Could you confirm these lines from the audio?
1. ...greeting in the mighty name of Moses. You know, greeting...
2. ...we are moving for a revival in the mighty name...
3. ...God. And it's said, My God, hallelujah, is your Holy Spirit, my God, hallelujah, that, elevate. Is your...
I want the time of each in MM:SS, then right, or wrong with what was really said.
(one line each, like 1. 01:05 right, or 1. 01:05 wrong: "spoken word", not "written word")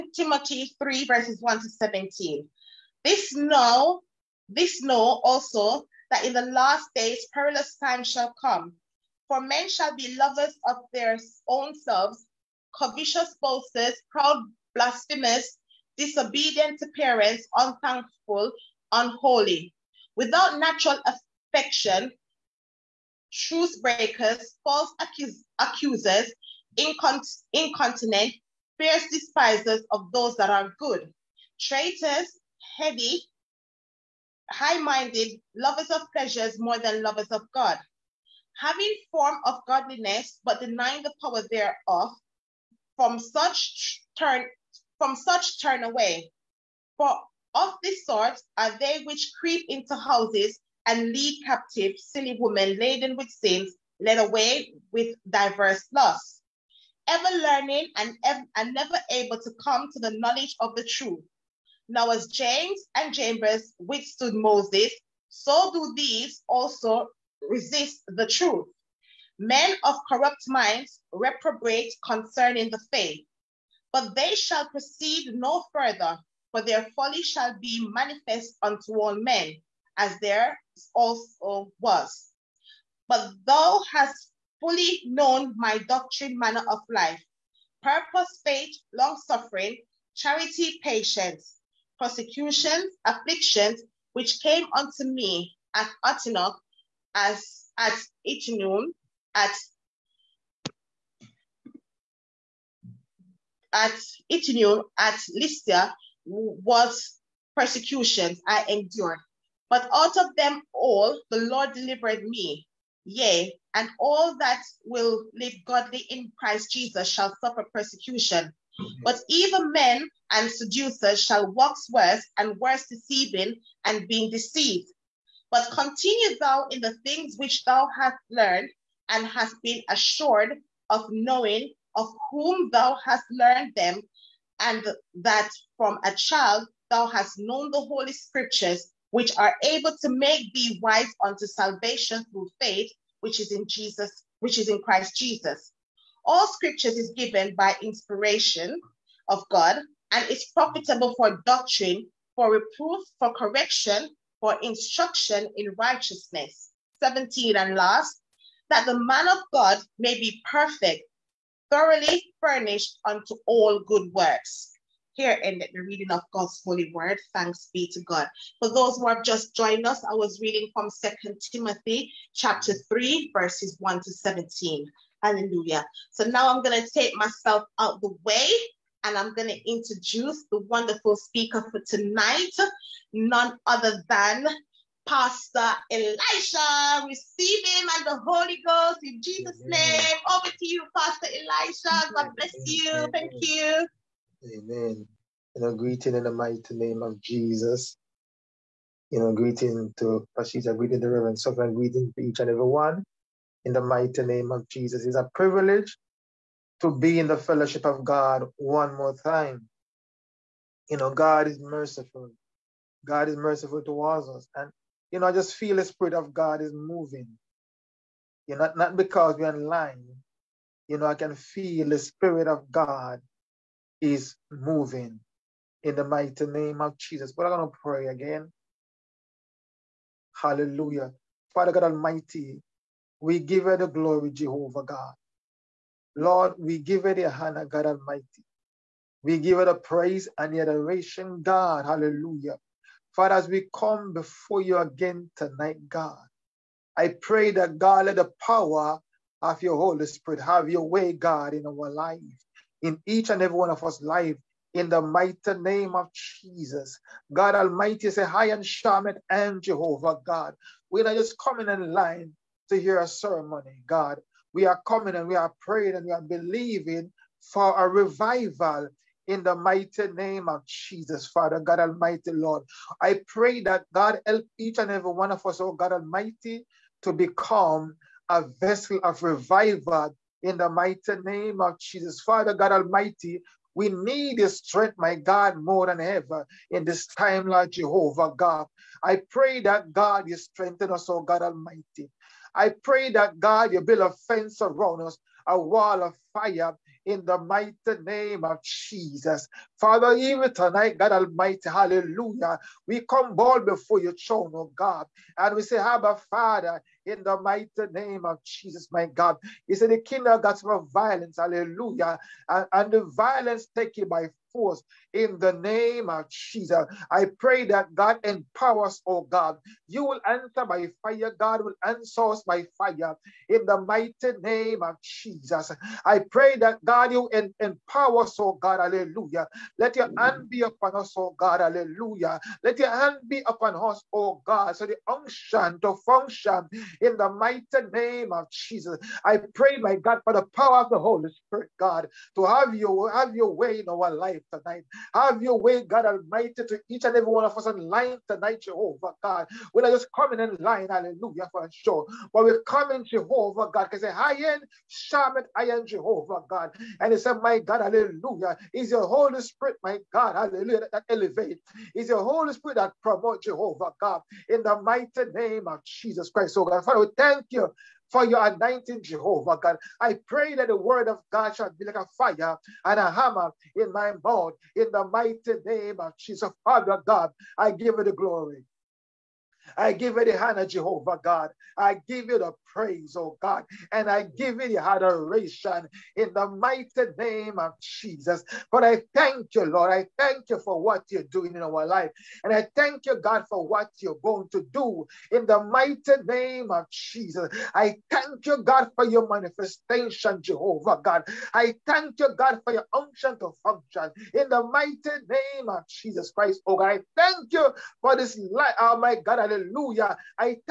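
1. 03:15 wrong: "Jesus", not "Moses"
2. 04:26 wrong: "believing", not "moving"
3. 05:56 right.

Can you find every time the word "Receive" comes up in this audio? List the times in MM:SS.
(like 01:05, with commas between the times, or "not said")
03:07.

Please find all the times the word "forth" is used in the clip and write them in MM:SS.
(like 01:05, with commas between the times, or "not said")
05:14.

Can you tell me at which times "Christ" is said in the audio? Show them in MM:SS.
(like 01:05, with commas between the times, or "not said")
01:56, 02:24, 06:06, 06:46.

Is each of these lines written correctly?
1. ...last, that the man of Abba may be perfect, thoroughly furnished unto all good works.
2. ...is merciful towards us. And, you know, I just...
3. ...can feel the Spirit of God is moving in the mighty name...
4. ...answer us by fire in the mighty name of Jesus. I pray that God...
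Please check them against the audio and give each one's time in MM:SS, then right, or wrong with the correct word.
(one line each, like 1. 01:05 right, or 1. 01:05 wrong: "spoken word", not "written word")
1. 02:37 wrong: "God", not "Abba"
2. 03:33 right
3. 03:41 right
4. 05:21 right.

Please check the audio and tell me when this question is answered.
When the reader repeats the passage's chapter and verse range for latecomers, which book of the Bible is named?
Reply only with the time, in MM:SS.
02:50.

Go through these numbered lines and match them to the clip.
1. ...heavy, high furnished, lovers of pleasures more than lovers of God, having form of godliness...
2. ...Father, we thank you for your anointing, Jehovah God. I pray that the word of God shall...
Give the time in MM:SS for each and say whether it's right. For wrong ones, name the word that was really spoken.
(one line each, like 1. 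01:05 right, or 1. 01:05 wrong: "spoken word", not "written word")
1. 00:32 wrong: "minded", not "furnished"
2. 06:06 right.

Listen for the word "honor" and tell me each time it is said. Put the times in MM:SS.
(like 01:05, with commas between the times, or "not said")
03:57, 06:20.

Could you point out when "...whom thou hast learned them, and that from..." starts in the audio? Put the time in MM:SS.
02:12.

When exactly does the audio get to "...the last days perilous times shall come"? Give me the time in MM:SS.
00:06.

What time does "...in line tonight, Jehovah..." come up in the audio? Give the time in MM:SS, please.
05:47.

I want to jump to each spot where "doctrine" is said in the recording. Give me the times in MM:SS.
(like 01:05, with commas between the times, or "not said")
01:25, 02:31.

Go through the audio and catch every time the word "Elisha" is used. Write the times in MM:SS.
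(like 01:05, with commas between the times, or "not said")
03:05, 03:11.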